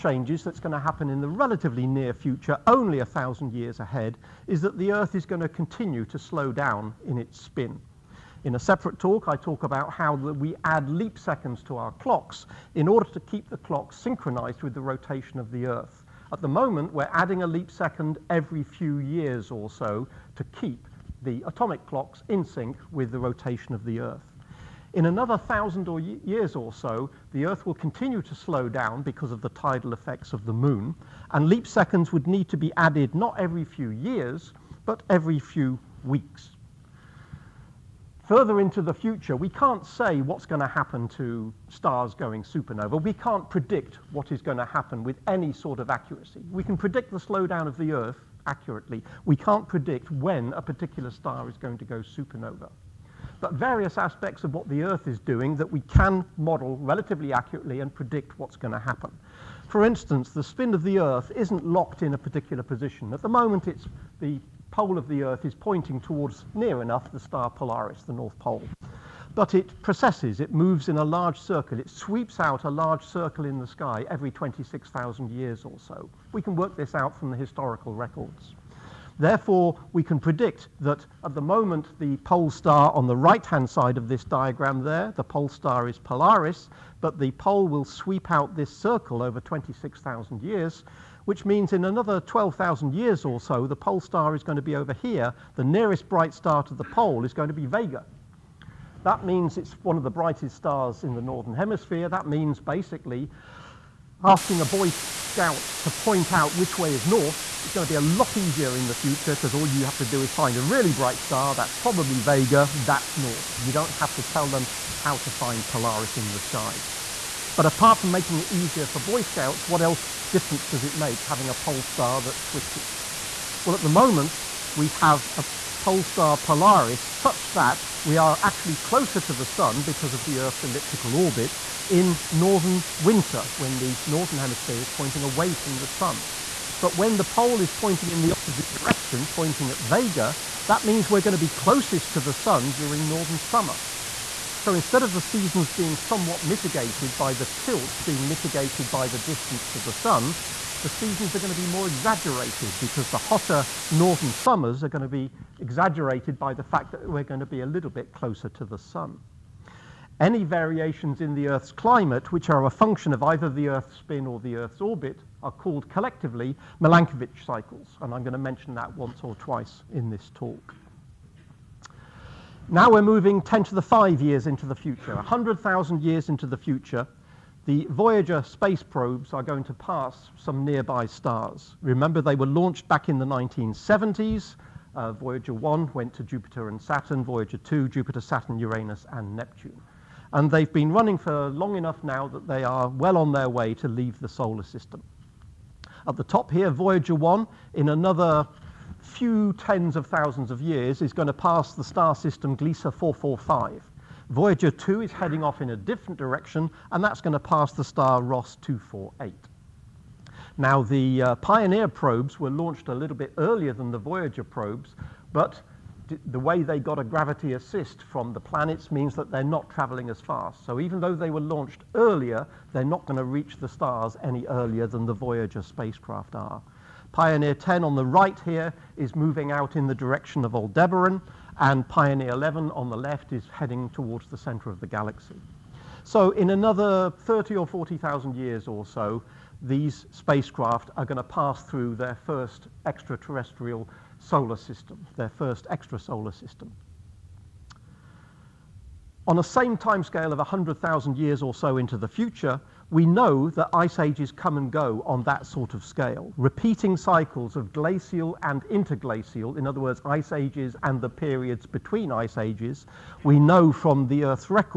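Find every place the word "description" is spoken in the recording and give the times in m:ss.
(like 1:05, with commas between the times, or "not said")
not said.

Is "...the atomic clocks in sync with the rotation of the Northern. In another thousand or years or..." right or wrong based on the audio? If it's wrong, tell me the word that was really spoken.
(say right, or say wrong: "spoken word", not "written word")
wrong: "Earth", not "Northern".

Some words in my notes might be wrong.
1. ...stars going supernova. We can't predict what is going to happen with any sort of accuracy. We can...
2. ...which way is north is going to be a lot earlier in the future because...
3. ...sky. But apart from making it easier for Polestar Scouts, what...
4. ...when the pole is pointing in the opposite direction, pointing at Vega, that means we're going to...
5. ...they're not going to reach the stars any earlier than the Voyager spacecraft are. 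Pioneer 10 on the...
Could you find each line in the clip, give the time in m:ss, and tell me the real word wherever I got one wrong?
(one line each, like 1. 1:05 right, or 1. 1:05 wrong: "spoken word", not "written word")
1. 0:41 right
2. 1:46 wrong: "easier", not "earlier"
3. 1:56 wrong: "Boy", not "Polestar"
4. 2:16 right
5. 3:42 right.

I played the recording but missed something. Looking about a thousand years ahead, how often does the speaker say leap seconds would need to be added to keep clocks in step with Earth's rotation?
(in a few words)
every few weeks.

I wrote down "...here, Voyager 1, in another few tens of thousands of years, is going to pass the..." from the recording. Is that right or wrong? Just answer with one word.
right.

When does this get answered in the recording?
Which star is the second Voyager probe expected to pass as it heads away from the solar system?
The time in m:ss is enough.
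3:28.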